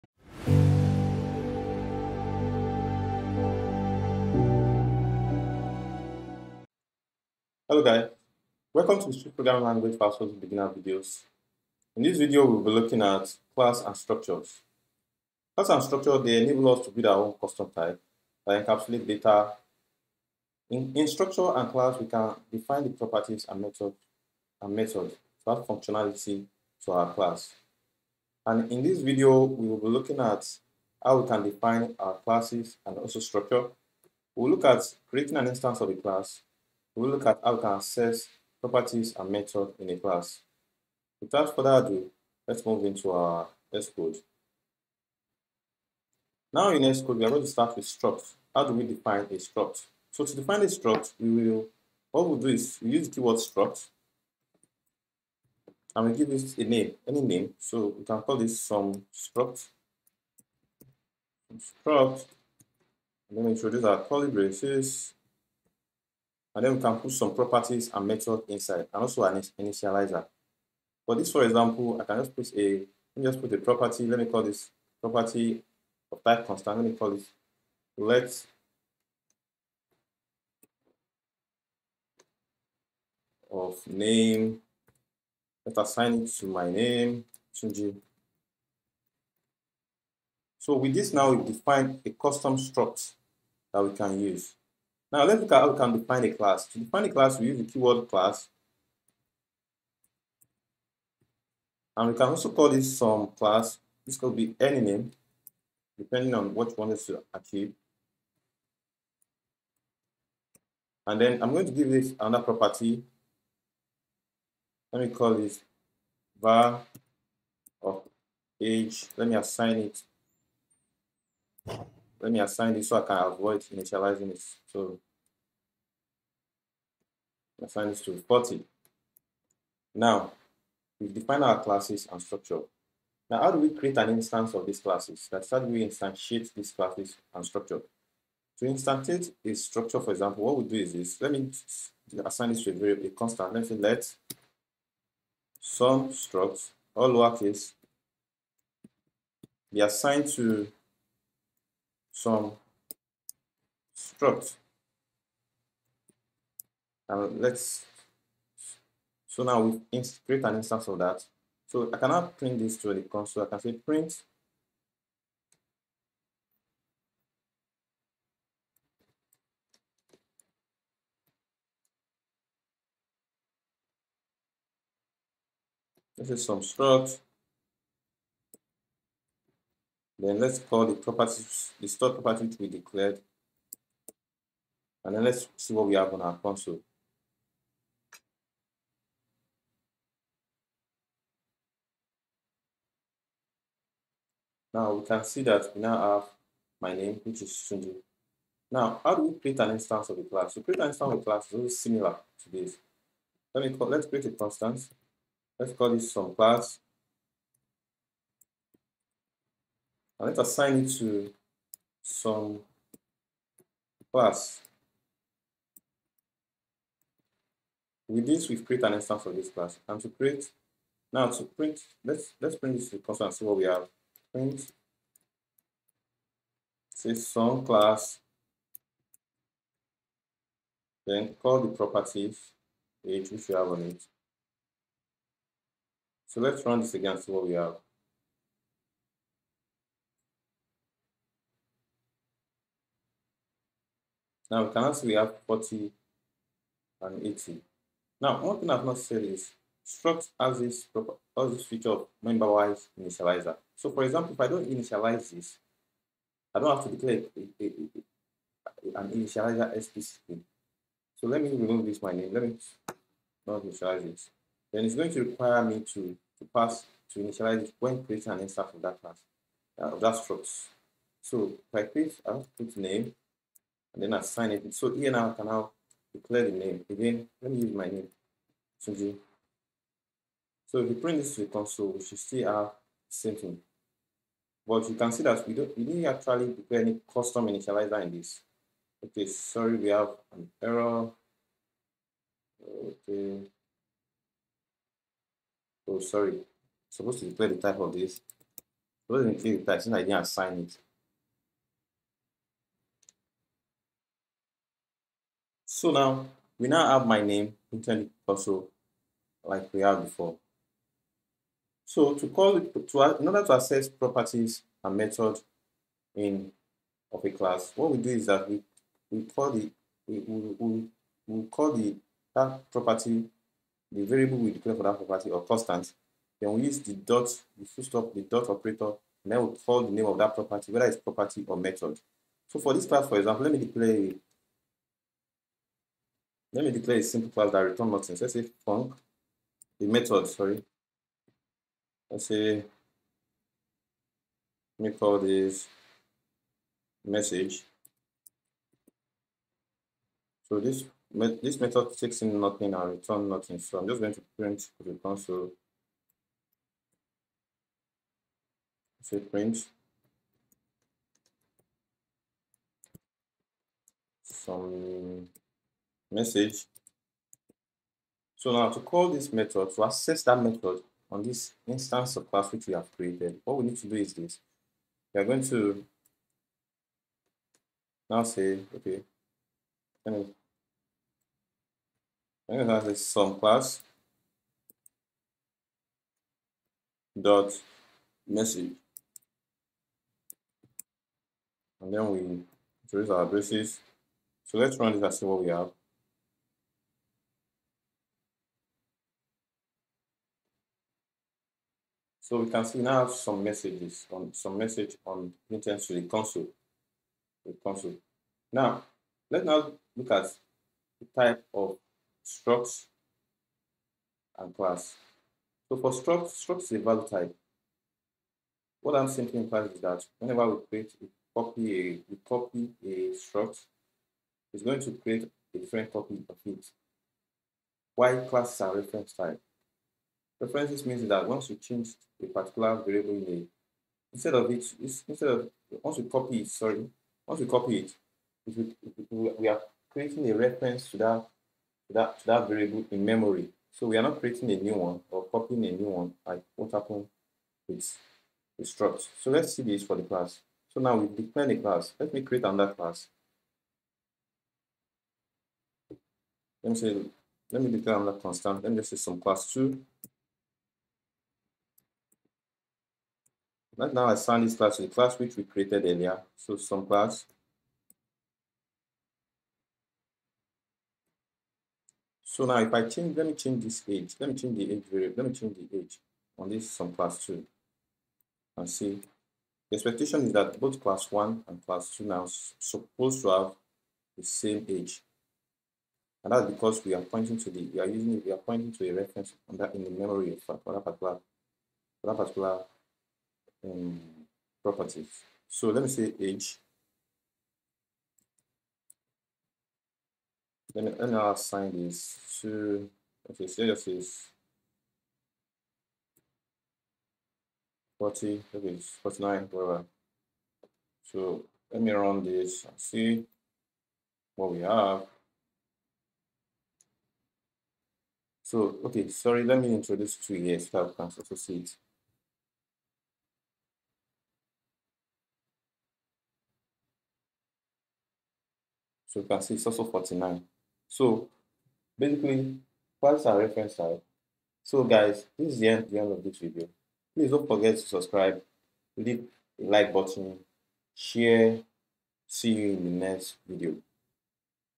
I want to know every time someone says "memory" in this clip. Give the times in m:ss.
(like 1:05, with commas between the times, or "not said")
7:23, 8:09.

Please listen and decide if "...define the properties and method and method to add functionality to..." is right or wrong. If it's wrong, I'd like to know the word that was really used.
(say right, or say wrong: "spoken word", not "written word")
right.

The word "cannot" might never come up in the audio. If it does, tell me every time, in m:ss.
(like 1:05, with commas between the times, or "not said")
2:41, 4:04.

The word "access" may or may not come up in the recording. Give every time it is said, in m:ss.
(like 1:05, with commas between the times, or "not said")
0:37, 5:13, 6:09.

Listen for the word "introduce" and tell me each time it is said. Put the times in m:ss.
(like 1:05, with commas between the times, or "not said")
1:03, 6:32, 8:39.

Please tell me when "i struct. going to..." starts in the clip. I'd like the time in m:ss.
1:01.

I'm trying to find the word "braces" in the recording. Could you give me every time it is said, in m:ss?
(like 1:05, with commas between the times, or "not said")
1:04, 6:33.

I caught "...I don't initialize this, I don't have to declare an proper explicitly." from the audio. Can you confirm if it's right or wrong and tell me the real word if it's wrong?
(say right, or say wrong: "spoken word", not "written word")
wrong: "initializer", not "proper".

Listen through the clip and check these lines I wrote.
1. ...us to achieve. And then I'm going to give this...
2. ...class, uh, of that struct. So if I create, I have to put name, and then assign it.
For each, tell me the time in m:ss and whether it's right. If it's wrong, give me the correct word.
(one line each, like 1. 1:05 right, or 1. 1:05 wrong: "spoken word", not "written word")
1. 1:46 right
2. 4:29 right.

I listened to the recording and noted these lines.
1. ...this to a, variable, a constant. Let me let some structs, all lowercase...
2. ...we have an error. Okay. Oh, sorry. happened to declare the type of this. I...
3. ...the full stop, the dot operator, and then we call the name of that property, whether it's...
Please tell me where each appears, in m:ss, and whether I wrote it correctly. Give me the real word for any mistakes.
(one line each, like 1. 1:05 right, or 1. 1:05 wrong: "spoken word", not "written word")
1. 2:22 right
2. 4:49 wrong: "supposed", not "happened"
3. 5:27 right.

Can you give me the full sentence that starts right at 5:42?
Let's say, let me call this message.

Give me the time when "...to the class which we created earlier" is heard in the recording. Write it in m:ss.
7:44.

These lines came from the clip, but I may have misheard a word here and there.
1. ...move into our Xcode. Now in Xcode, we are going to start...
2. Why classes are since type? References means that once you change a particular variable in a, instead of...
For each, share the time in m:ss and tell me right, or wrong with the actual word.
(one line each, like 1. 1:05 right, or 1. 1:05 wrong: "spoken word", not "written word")
1. 0:42 right
2. 7:07 wrong: "reference", not "since".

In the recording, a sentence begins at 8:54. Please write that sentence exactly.
So guys, this is the end, the end of this video.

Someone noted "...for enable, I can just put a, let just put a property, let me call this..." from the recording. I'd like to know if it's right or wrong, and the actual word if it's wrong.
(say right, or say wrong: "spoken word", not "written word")
wrong: "example", not "enable".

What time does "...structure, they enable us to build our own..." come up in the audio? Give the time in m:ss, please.
0:15.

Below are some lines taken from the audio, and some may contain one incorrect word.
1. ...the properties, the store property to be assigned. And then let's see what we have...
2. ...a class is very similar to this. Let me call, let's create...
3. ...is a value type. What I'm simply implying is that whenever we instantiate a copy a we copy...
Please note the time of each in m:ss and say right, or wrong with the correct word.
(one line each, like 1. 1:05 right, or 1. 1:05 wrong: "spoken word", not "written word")
1. 3:00 wrong: "declared", not "assigned"
2. 3:21 right
3. 6:56 wrong: "create", not "instantiate".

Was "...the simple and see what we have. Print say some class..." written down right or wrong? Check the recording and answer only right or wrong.
wrong.